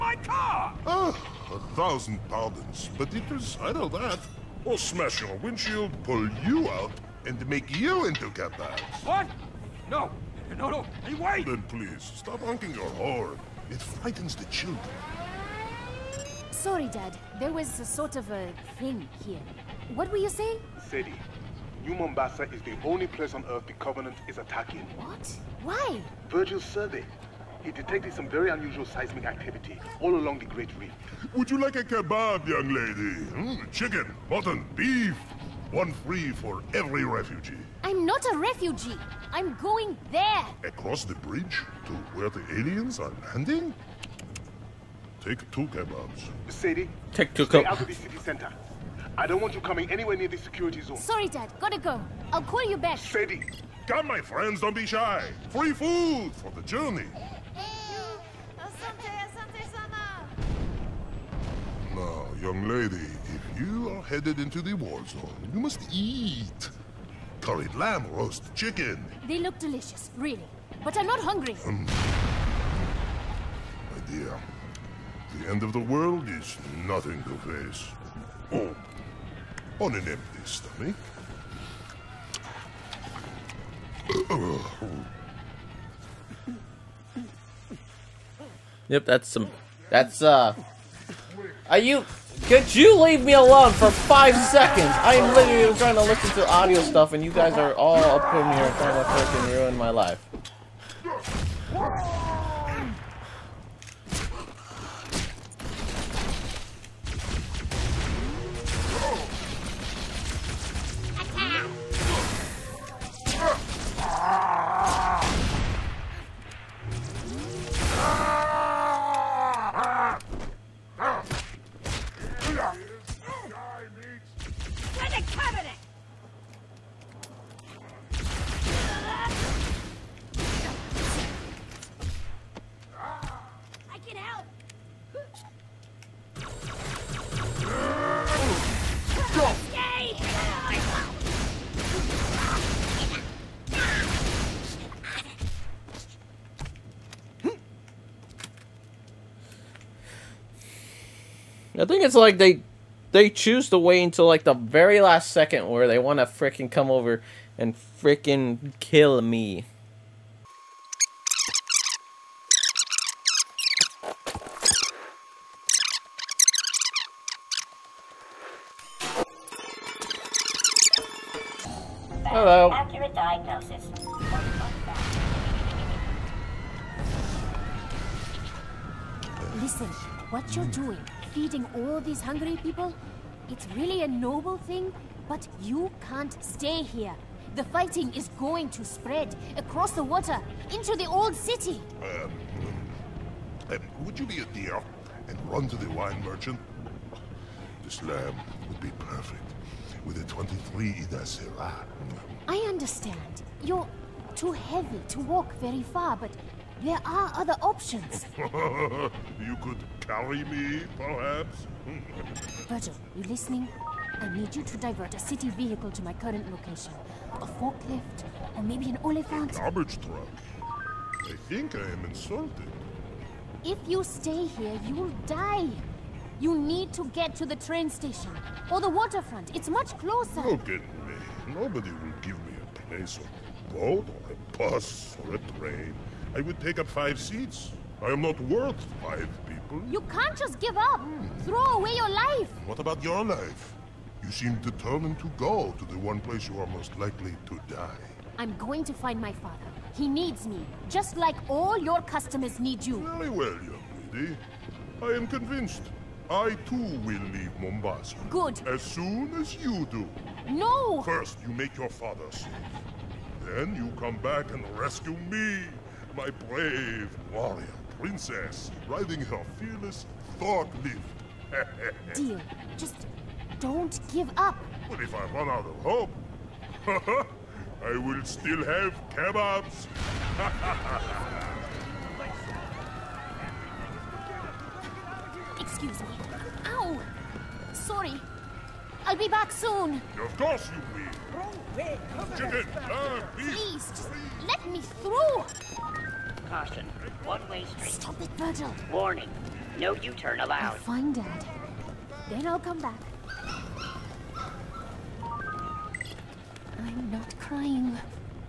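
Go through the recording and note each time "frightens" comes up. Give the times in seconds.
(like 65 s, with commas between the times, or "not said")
13 s.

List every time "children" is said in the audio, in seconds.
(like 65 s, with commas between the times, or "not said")
14 s.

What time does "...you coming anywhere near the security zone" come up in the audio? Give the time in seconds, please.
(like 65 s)
49 s.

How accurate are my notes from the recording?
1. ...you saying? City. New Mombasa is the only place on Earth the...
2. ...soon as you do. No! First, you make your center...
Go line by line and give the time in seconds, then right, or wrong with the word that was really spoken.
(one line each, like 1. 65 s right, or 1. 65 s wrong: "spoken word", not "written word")
1. 20 s right
2. 258 s wrong: "father", not "center".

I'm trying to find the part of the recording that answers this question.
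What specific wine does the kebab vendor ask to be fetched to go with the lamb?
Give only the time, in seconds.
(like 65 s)
200 s.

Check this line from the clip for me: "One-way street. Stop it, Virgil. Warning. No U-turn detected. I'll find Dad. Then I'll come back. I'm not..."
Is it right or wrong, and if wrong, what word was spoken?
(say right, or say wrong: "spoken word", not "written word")
wrong: "allowed", not "detected".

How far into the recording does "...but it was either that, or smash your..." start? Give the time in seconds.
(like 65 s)
2 s.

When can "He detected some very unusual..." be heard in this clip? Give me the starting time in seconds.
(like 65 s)
27 s.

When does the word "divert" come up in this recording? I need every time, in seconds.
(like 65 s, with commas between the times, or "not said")
214 s.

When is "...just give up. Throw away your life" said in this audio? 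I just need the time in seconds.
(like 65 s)
240 s.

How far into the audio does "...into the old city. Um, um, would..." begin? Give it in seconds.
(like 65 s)
190 s.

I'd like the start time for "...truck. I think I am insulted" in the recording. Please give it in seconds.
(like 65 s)
220 s.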